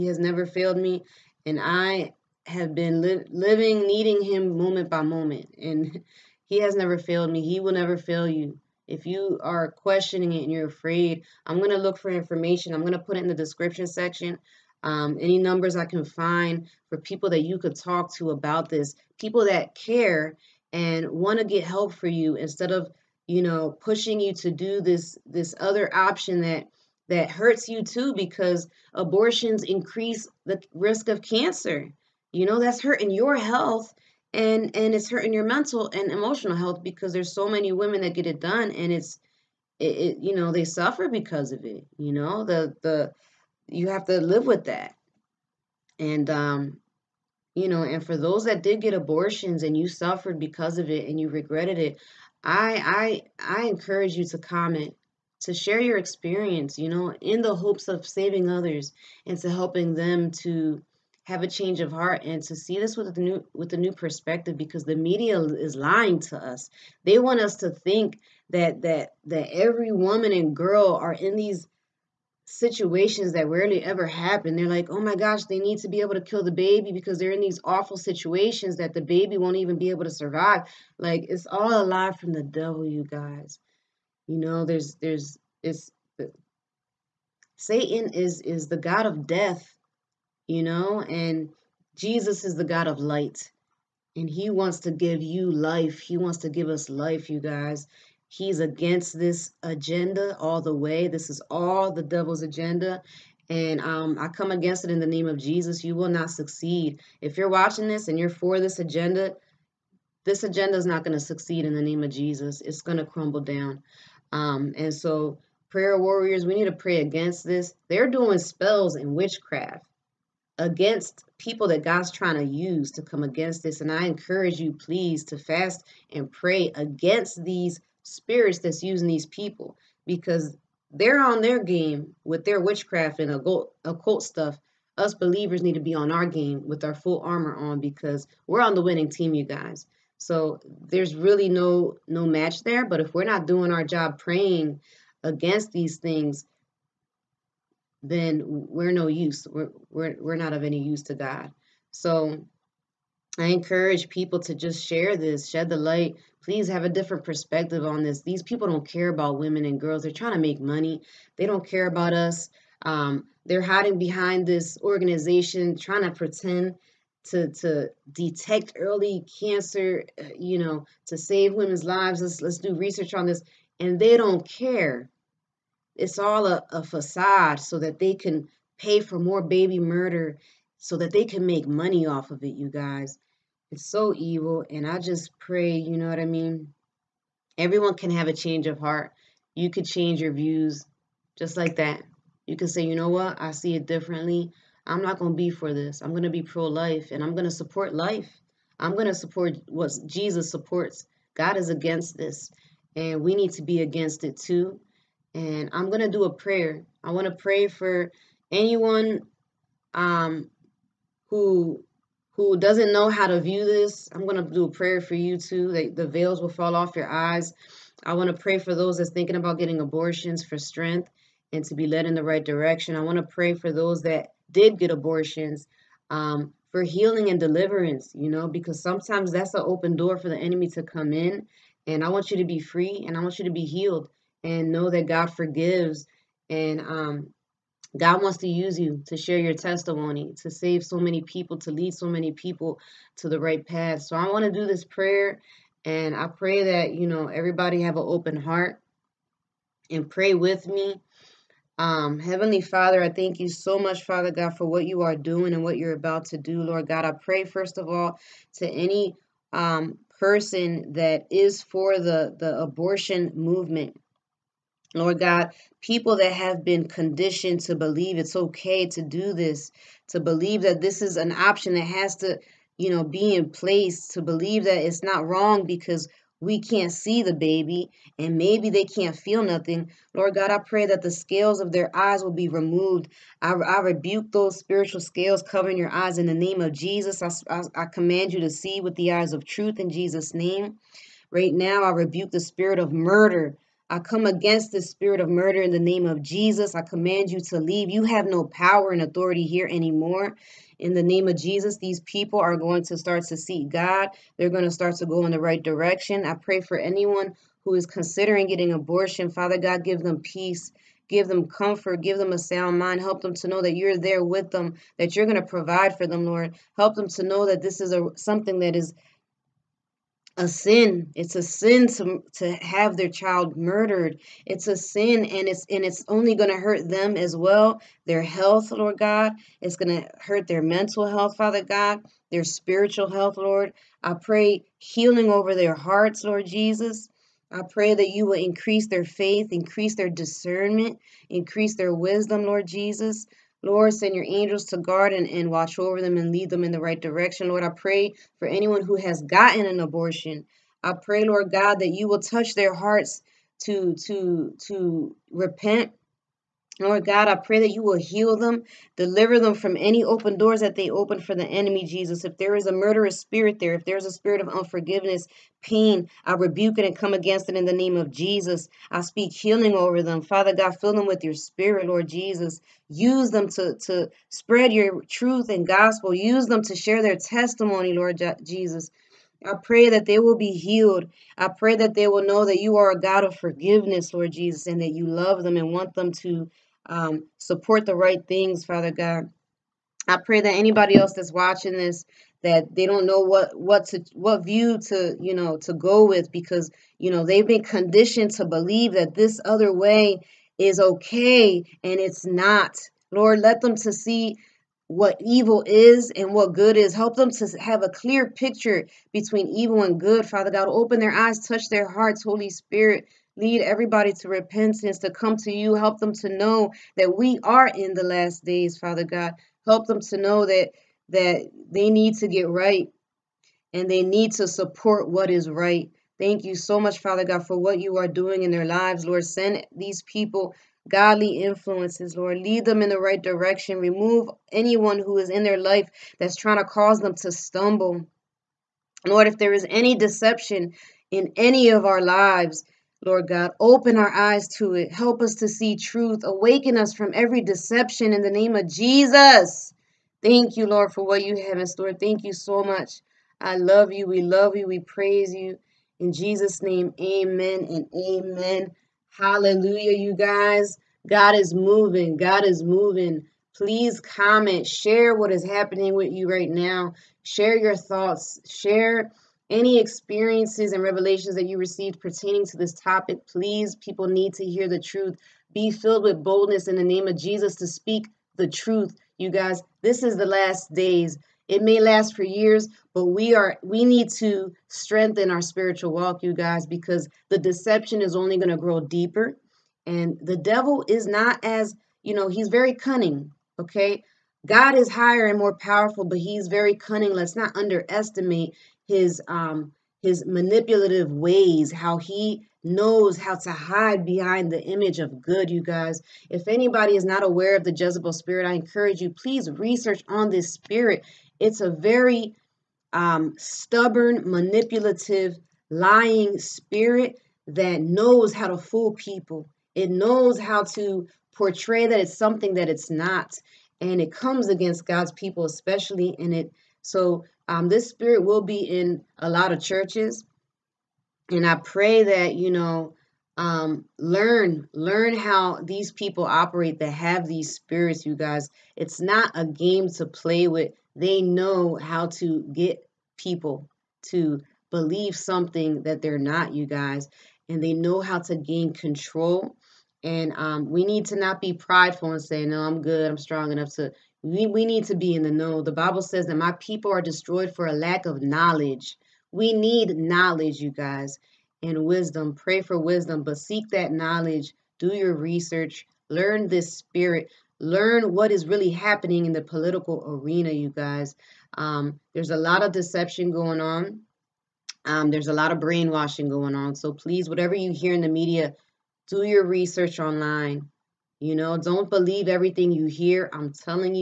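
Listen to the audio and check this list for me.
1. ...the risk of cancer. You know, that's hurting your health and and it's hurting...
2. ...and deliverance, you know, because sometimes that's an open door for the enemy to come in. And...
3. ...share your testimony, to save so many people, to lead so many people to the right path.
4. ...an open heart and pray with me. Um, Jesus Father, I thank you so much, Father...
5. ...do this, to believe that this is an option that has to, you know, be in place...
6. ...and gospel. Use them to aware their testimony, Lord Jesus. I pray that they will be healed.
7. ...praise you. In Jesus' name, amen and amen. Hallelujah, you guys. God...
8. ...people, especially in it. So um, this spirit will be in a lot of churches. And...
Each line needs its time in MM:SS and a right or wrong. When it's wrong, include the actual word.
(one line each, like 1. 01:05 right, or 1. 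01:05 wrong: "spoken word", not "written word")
1. 00:30 right
2. 03:47 right
3. 03:59 right
4. 04:07 wrong: "Heavenly", not "Jesus"
5. 04:29 right
6. 06:15 wrong: "share", not "aware"
7. 07:34 right
8. 08:45 right.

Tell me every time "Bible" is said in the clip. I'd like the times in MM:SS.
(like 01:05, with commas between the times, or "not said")
09:15.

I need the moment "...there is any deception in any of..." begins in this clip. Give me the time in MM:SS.
07:19.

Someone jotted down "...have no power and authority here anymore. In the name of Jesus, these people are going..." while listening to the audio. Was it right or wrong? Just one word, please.
right.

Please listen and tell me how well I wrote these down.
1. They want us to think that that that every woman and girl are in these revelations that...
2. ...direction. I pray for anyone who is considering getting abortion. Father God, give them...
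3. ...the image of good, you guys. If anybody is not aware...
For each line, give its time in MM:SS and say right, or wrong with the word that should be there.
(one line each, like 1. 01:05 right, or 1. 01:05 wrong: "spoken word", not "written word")
1. 01:07 wrong: "situations", not "revelations"
2. 05:05 right
3. 08:24 right.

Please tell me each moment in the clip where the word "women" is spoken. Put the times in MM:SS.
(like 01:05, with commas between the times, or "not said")
00:37, 02:39, 02:51.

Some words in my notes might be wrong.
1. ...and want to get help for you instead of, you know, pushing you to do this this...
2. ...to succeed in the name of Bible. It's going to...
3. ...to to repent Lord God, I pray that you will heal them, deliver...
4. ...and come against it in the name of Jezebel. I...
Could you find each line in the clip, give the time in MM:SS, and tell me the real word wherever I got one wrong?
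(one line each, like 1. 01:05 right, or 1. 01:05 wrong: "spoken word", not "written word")
1. 00:20 right
2. 01:51 wrong: "Jesus", not "Bible"
3. 05:53 right
4. 06:06 wrong: "Jesus", not "Jezebel".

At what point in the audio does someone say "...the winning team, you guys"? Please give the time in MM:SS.
02:18.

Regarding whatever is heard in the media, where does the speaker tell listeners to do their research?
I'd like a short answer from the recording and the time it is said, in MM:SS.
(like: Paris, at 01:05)
online, at 09:39.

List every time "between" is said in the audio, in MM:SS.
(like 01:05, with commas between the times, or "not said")
06:49.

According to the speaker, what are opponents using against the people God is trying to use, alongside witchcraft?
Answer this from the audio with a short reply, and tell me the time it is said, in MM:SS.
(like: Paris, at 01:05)
spells, at 01:58.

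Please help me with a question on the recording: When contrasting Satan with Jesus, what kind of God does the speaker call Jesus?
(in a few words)
God of light.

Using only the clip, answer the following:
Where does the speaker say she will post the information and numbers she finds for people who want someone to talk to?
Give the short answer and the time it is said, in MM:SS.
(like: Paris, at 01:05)
description section, at 00:13.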